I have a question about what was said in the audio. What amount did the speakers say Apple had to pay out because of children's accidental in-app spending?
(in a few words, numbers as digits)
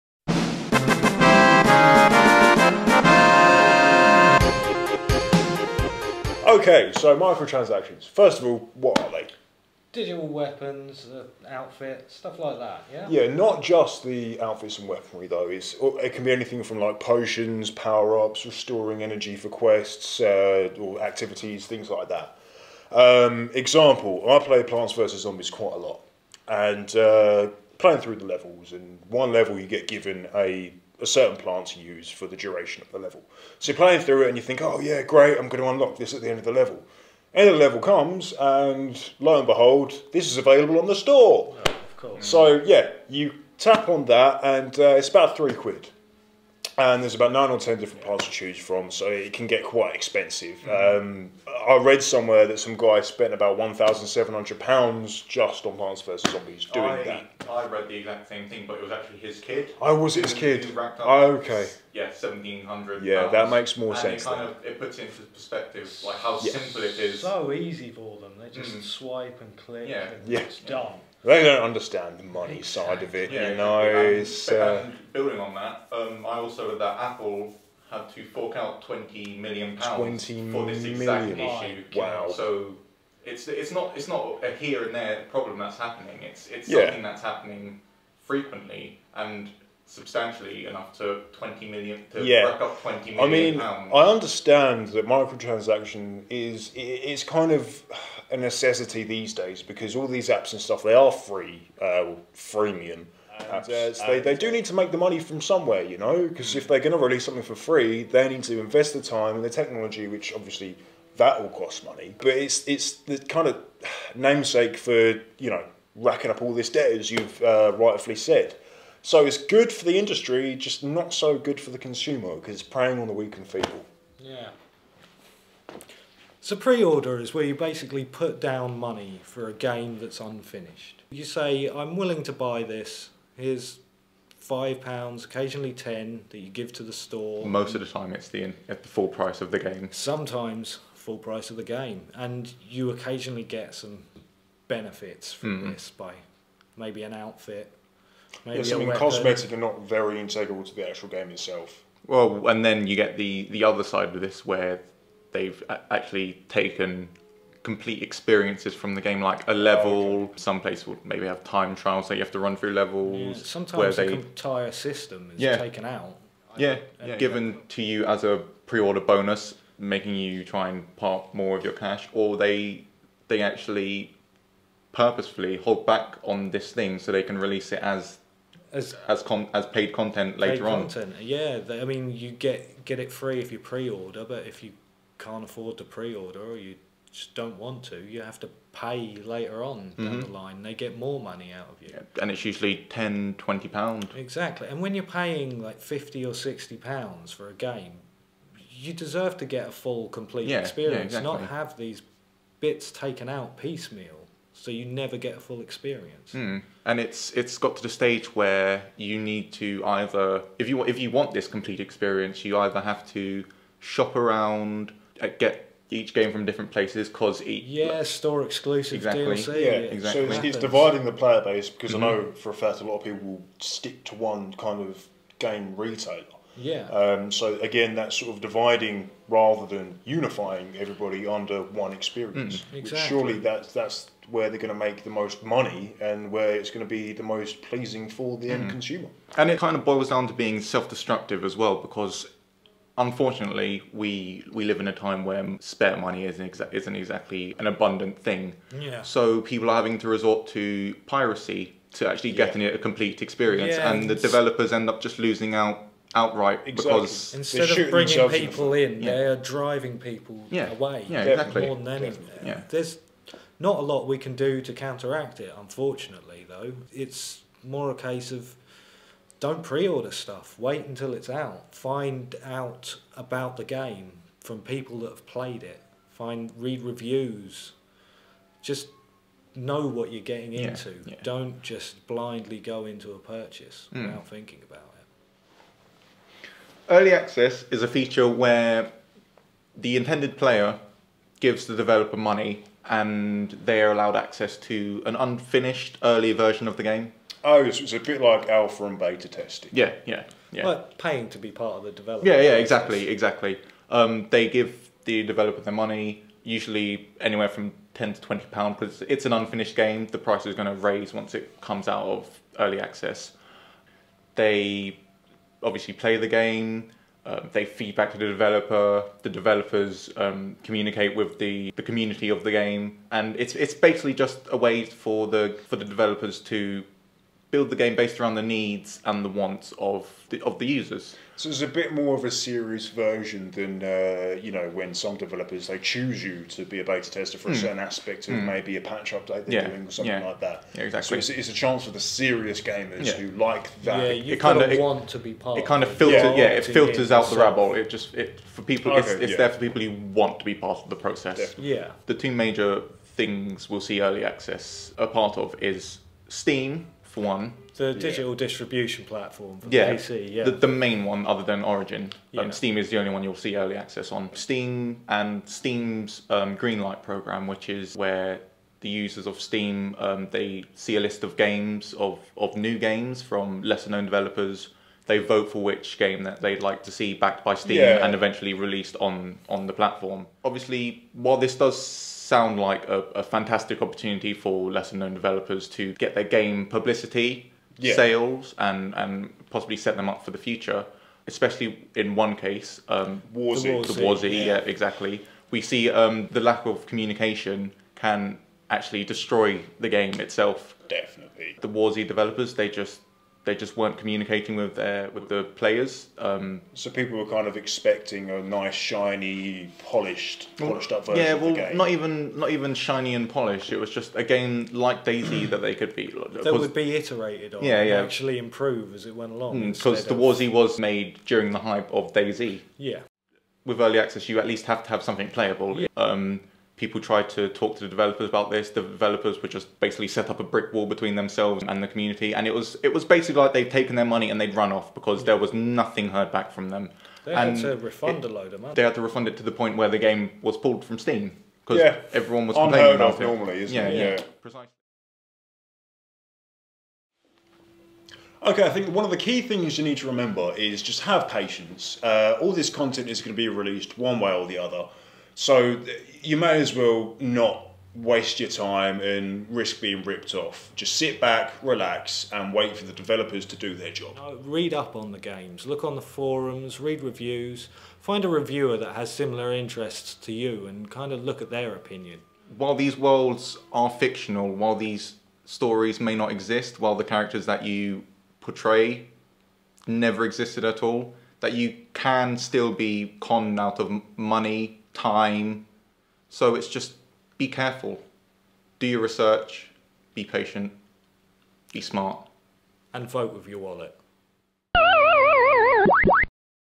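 £20 million.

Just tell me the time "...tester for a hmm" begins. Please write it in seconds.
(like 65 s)
337 s.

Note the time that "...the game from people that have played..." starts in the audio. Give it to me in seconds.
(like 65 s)
273 s.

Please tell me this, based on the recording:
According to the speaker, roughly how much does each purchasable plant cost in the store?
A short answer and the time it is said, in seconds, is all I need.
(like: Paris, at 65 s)
about £3, at 45 s.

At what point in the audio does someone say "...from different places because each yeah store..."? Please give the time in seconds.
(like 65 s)
216 s.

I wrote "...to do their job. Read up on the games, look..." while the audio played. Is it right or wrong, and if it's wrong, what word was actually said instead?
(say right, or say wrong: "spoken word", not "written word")
right.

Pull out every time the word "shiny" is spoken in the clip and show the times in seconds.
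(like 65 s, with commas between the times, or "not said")
408 s, 412 s.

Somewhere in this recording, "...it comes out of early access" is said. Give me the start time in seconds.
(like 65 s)
311 s.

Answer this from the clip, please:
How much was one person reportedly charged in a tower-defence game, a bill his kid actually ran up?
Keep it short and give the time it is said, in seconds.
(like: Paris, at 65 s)
£1,700, at 53 s.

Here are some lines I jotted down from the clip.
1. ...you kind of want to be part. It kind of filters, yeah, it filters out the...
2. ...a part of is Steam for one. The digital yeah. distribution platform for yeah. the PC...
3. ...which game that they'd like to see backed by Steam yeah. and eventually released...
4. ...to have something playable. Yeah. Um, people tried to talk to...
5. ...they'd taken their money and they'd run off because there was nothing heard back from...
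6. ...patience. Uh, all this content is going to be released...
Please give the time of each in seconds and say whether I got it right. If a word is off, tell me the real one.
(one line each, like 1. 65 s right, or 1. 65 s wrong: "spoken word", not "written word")
1. 344 s right
2. 354 s right
3. 375 s right
4. 424 s right
5. 433 s right
6. 451 s right.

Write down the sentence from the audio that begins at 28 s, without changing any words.
And one level, you get given a certain plants use for the duration of the level.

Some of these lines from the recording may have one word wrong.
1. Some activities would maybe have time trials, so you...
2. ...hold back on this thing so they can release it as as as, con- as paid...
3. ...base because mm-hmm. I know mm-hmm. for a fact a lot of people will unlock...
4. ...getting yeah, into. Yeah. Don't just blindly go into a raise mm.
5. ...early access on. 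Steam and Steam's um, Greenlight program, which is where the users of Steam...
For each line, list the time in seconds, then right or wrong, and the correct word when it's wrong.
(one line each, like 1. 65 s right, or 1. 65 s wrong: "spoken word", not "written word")
1. 160 s wrong: "places", not "activities"
2. 175 s right
3. 221 s wrong: "stick", not "unlock"
4. 280 s wrong: "purchase", not "raise"
5. 363 s right.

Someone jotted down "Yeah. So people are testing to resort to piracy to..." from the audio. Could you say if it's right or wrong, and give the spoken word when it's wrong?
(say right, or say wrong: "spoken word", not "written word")
wrong: "having", not "testing".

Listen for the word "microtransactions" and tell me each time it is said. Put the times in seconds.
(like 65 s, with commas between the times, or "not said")
7 s, 95 s.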